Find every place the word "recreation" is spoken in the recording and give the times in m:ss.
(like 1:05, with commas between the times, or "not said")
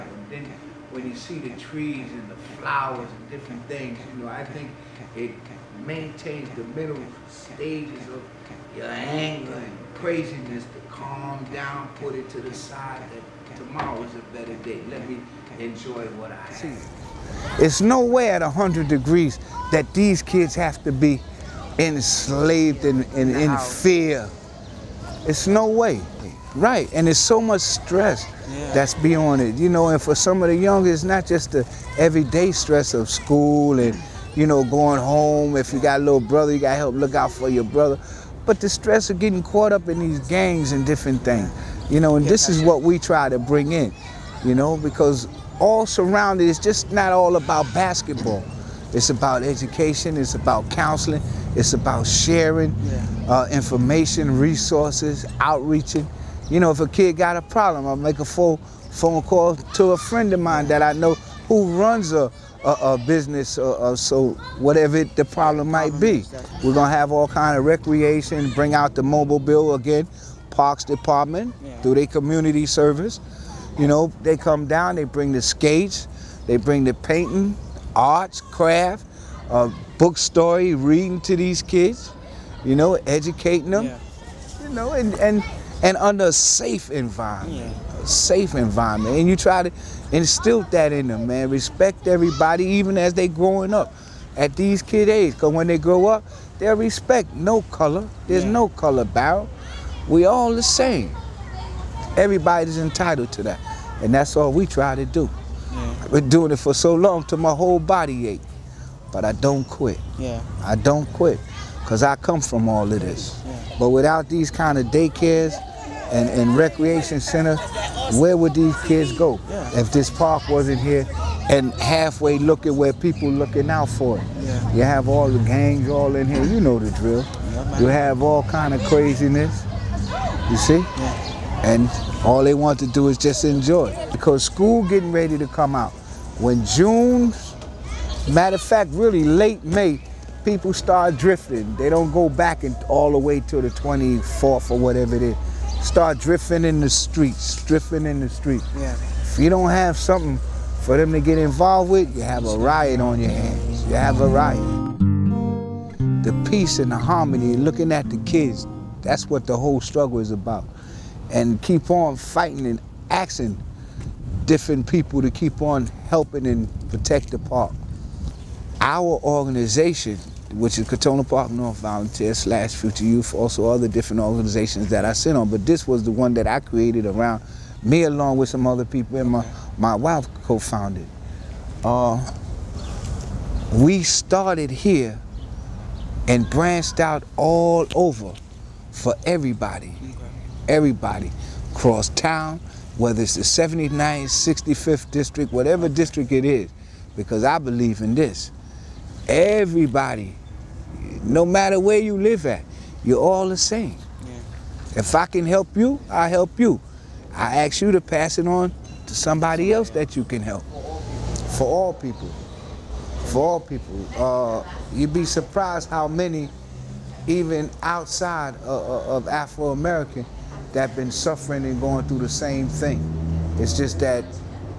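1:07, 1:56.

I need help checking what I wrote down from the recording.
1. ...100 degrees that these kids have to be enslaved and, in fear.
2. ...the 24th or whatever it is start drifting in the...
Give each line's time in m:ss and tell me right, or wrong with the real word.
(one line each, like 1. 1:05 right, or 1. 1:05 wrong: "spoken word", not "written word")
1. 0:18 right
2. 2:23 right.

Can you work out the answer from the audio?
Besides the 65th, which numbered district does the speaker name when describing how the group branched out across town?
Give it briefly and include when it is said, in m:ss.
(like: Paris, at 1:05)
79th, at 3:13.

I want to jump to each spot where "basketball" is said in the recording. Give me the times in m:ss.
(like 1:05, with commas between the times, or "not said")
0:47.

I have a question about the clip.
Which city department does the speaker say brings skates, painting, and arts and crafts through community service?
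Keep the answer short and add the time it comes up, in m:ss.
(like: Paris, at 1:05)
Parks department, at 1:10.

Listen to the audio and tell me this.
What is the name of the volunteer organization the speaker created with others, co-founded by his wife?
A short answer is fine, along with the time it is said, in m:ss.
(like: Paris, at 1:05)
Crotona Park North Volunteers, at 2:50.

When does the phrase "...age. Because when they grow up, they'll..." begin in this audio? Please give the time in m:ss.
1:35.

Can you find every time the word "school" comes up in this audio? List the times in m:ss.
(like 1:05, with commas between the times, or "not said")
0:33, 2:14.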